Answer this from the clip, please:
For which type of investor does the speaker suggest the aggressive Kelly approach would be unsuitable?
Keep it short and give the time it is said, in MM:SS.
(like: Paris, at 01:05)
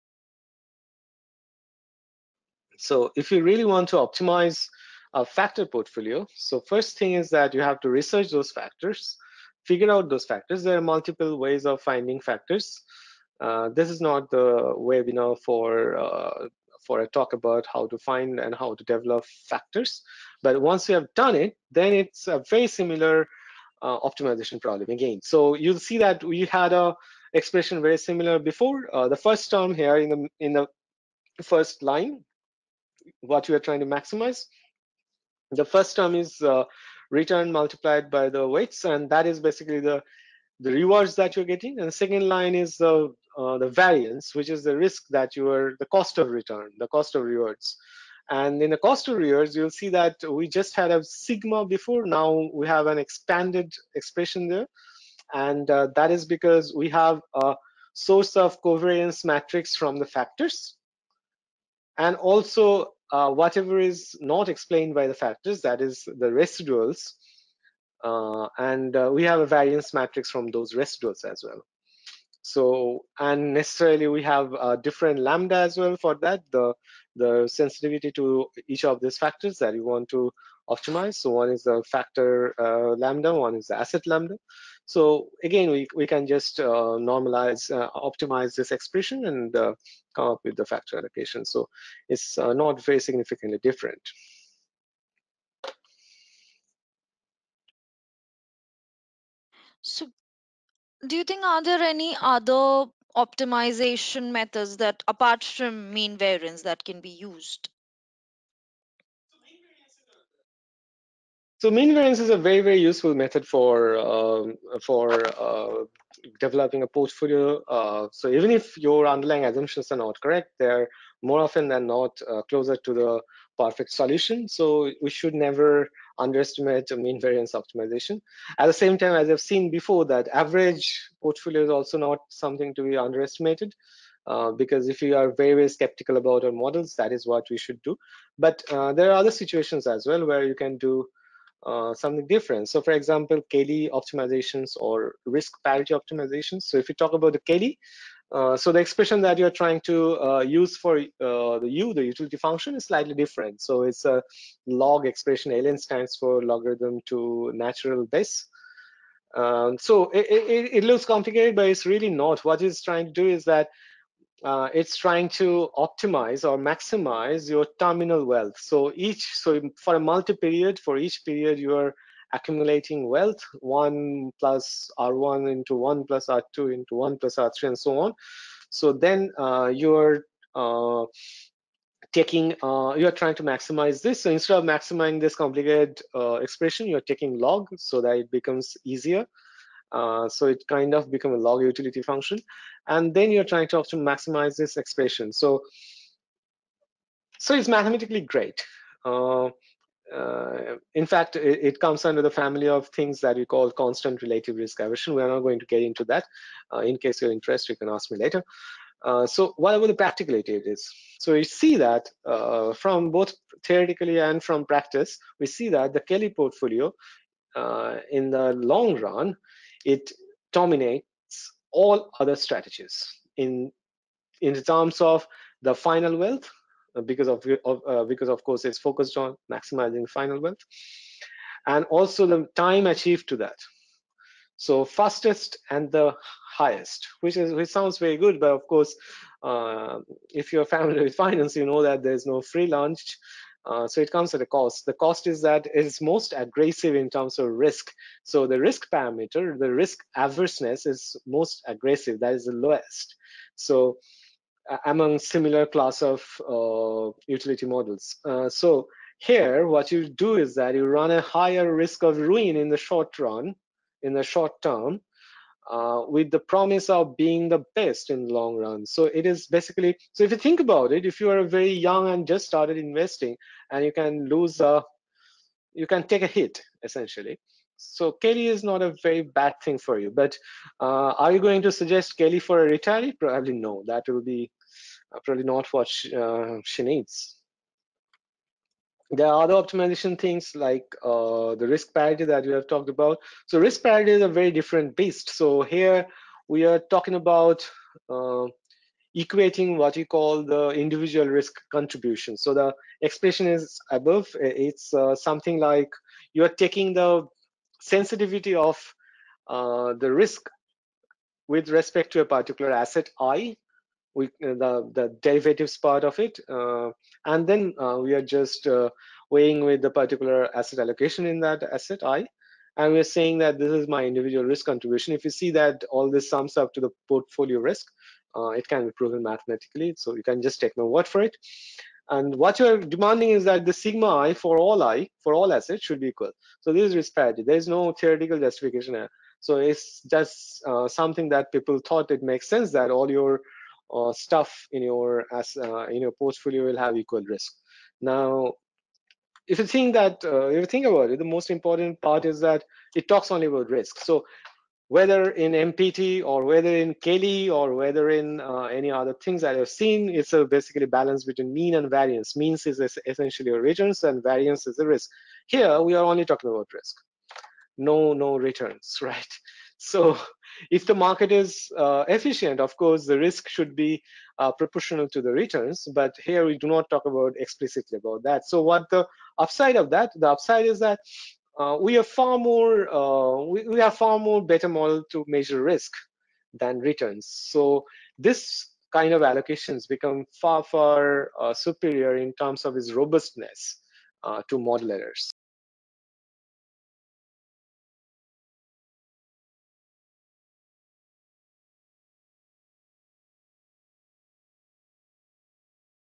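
a retiree, at 04:42.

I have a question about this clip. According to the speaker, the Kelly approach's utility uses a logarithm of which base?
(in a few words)
natural base.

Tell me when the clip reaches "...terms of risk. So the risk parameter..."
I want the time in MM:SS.
04:07.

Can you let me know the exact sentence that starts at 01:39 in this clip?
So do you think are there any other optimization methods that apart from mean variance that can be used?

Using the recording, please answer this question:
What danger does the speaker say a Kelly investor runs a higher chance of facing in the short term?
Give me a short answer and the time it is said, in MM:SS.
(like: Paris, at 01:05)
risk of ruin, at 04:21.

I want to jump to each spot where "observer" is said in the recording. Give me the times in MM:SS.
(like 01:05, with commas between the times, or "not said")
not said.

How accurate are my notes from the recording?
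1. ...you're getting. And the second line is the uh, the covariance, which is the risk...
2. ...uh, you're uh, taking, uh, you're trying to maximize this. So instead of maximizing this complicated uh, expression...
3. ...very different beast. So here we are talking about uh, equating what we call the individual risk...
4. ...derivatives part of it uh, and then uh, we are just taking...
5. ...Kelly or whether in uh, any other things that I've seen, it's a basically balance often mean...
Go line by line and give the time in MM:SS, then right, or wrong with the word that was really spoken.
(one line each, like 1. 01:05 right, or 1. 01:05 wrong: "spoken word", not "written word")
1. 00:41 wrong: "variance", not "covariance"
2. 02:59 right
3. 04:54 right
4. 05:15 wrong: "weighing", not "taking"
5. 05:56 wrong: "between", not "often".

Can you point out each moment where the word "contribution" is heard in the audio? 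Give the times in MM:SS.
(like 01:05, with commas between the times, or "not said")
05:01, 05:24.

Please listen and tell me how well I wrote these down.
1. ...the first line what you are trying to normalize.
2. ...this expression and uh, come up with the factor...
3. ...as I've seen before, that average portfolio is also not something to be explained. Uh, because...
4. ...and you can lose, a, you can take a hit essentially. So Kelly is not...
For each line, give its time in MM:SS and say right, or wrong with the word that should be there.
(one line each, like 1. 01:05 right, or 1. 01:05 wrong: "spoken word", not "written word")
1. 00:30 wrong: "maximize", not "normalize"
2. 01:28 right
3. 02:09 wrong: "underestimated", not "explained"
4. 04:33 right.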